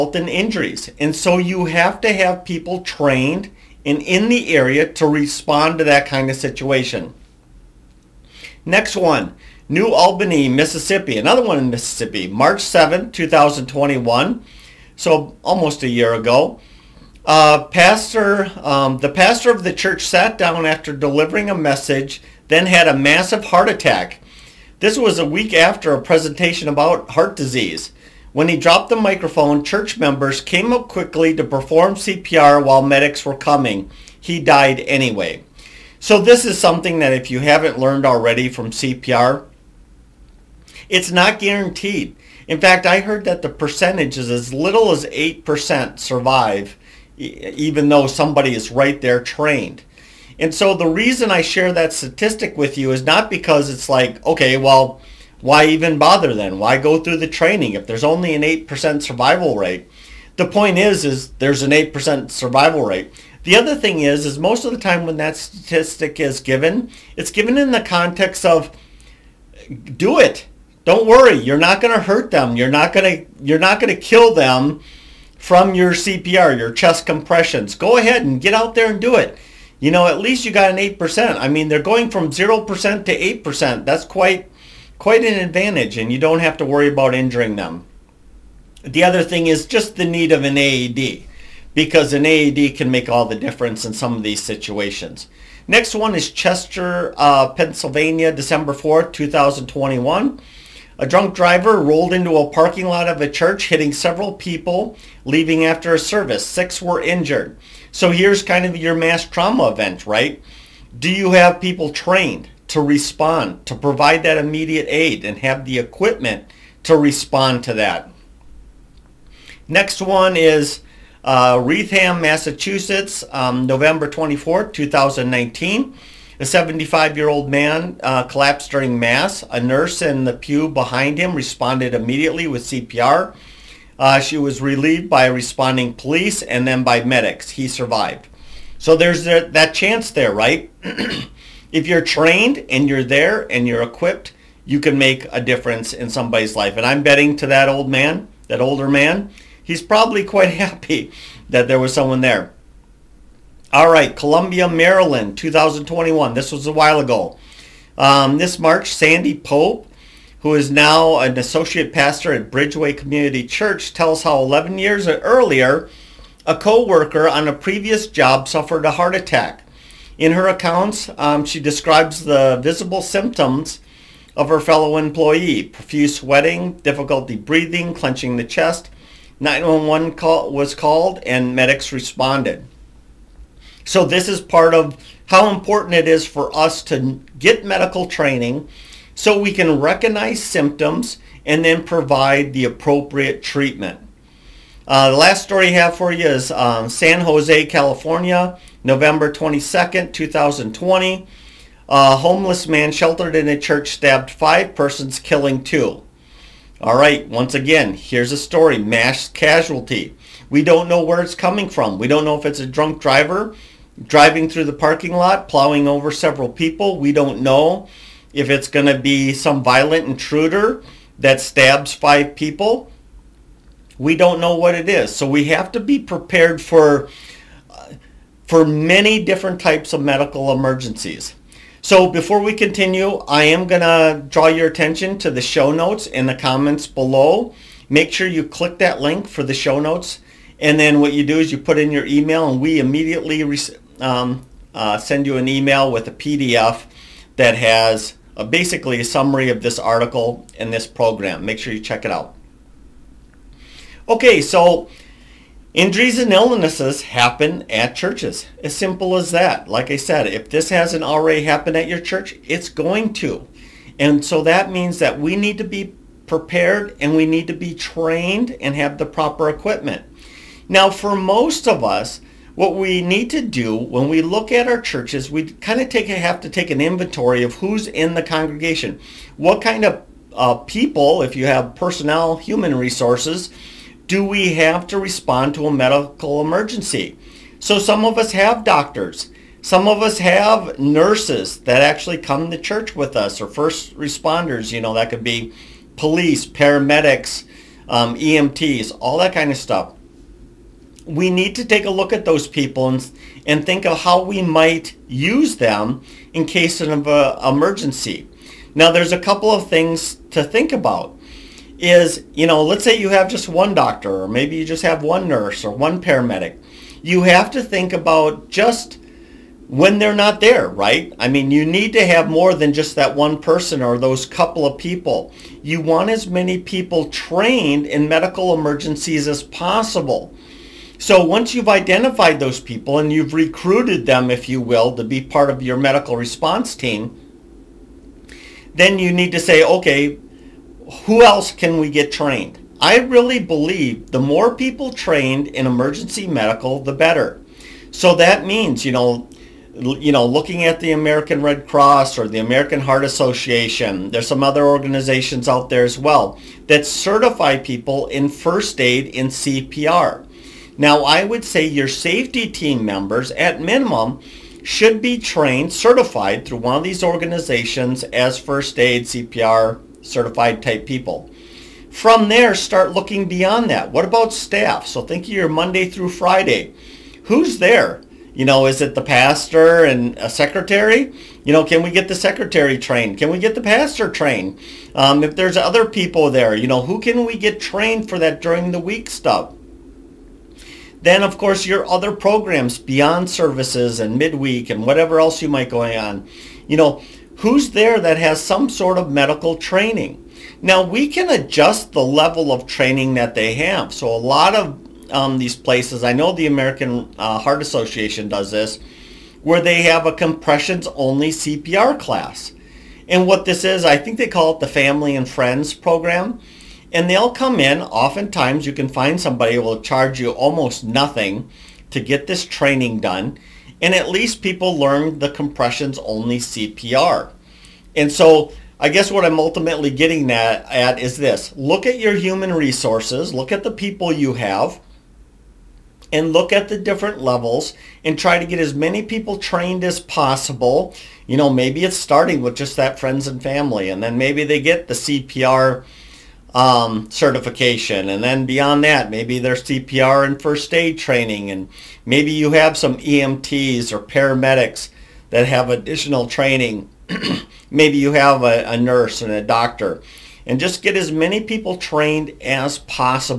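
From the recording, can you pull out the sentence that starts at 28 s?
When he dropped the microphone, church members came up quickly to perform CPR while medics were coming.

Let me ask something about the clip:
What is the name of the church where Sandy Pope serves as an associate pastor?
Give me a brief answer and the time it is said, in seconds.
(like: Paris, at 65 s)
Bridgeway Community Church, at 162 s.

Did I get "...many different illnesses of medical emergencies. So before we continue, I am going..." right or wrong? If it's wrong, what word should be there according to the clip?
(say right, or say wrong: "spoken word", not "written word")
wrong: "types", not "illnesses".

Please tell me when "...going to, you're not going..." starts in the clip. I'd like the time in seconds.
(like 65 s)
72 s.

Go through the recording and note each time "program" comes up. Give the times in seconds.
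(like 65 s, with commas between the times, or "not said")
250 s, 392 s, 415 s.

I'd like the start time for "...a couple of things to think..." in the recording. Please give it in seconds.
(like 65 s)
309 s.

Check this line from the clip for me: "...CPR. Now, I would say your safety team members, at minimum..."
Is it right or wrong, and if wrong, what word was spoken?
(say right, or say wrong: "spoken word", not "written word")
right.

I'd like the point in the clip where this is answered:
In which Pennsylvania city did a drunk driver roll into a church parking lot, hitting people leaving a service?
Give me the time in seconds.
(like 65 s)
96 s.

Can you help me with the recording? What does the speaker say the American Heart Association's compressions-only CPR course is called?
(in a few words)
Family and Friends.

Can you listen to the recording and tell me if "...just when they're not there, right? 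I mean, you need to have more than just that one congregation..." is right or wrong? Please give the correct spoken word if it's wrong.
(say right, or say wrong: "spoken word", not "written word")
wrong: "person", not "congregation".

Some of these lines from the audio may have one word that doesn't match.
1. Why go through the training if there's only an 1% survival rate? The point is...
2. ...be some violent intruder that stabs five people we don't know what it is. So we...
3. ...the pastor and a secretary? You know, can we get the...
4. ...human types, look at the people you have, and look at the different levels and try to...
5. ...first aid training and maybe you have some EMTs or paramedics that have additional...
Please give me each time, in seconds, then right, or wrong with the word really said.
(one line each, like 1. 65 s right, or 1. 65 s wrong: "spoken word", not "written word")
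1. 56 s wrong: "8", not "1"
2. 218 s right
3. 378 s right
4. 432 s wrong: "resources", not "types"
5. 450 s right.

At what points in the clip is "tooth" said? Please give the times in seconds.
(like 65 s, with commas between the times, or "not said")
not said.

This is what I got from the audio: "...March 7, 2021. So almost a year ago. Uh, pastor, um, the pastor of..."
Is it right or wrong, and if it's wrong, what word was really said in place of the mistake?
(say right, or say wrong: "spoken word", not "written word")
right.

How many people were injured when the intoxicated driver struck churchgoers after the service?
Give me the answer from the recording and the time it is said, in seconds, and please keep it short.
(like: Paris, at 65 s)
6, at 106 s.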